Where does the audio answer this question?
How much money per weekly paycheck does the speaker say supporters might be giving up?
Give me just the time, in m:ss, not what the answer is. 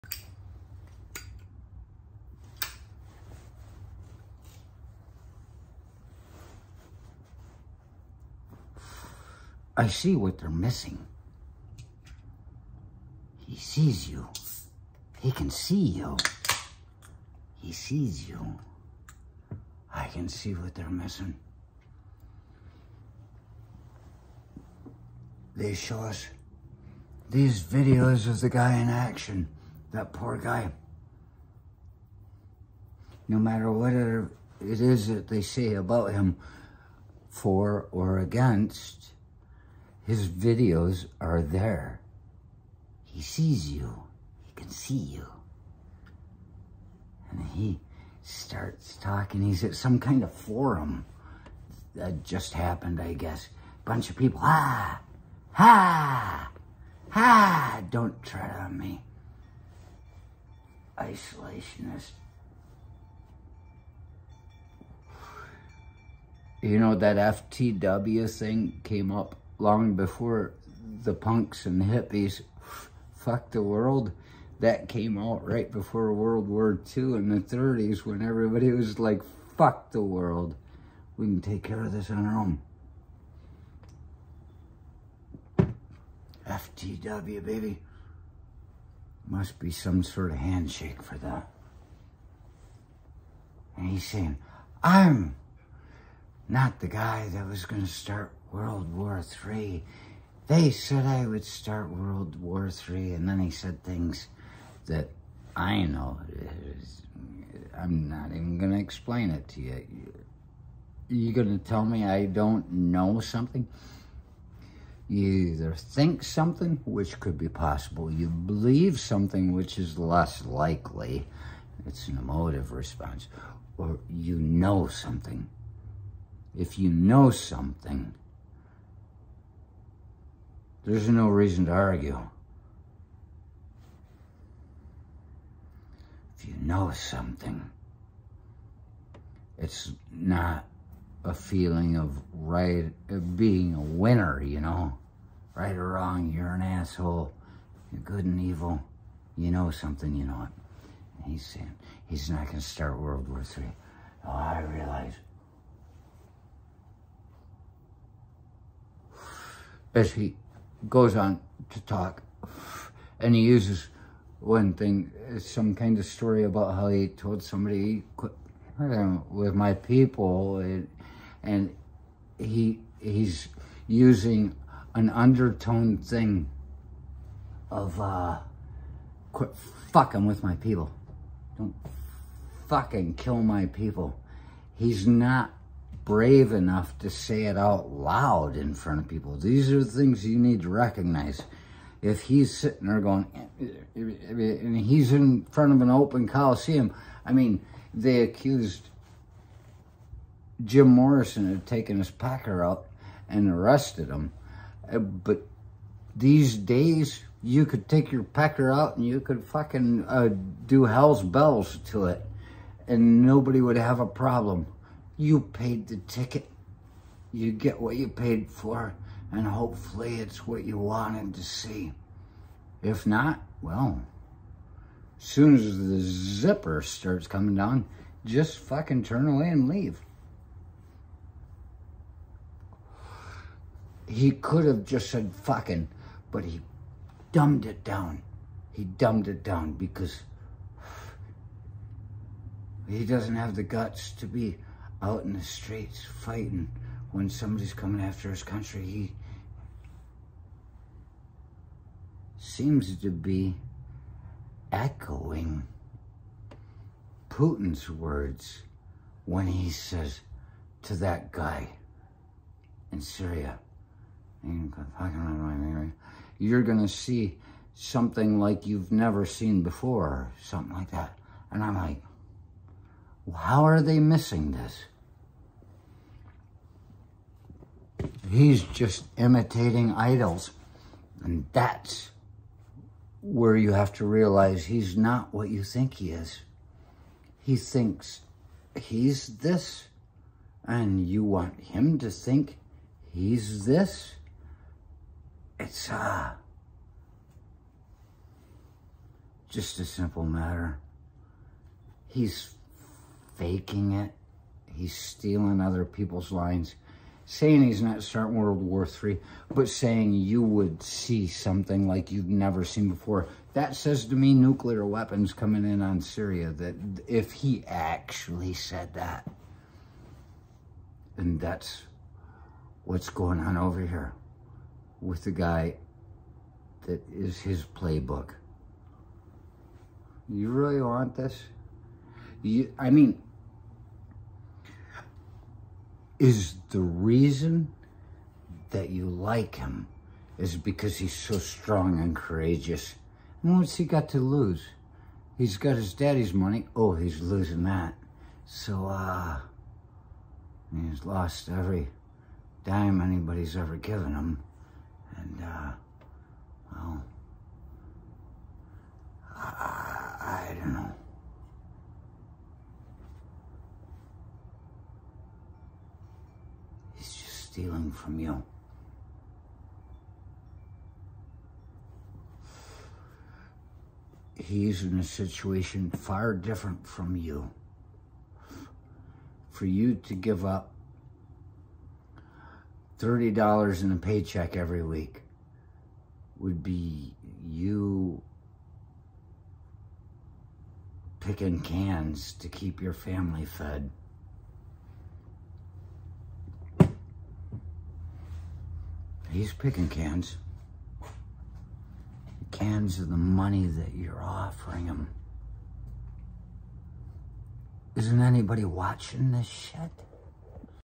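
6:22.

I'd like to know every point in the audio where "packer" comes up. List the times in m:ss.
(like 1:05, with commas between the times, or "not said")
3:22, 3:28.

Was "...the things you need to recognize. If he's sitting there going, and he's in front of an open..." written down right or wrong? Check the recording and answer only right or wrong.
right.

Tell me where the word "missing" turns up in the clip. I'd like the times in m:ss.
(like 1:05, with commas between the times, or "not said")
0:10, 0:20, 4:33.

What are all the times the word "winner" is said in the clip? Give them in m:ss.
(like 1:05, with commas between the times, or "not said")
2:23.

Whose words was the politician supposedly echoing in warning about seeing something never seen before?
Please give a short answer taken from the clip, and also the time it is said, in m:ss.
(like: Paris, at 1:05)
Putin, at 4:17.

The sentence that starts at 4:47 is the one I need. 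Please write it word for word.
He thinks he's this, and you want him to think he's this.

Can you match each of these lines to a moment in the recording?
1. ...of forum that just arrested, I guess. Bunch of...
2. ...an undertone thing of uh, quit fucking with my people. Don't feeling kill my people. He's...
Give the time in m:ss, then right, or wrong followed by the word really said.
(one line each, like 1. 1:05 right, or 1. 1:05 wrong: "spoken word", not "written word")
1. 0:50 wrong: "happened", not "arrested"
2. 2:54 wrong: "fucking", not "feeling".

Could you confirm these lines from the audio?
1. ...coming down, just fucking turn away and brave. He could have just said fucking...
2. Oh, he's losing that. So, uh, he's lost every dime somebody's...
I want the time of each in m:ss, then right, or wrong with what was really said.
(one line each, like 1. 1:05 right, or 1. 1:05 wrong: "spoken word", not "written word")
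1. 3:47 wrong: "leave", not "brave"
2. 5:46 wrong: "anybody", not "somebody".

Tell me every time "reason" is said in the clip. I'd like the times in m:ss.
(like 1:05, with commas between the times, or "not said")
2:11, 5:36.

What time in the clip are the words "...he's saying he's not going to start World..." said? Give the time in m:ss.
2:31.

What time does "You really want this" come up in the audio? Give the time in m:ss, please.
5:30.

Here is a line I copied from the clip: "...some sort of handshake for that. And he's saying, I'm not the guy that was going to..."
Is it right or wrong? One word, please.
right.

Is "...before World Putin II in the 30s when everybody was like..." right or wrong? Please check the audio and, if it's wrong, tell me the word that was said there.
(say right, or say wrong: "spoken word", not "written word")
wrong: "War", not "Putin".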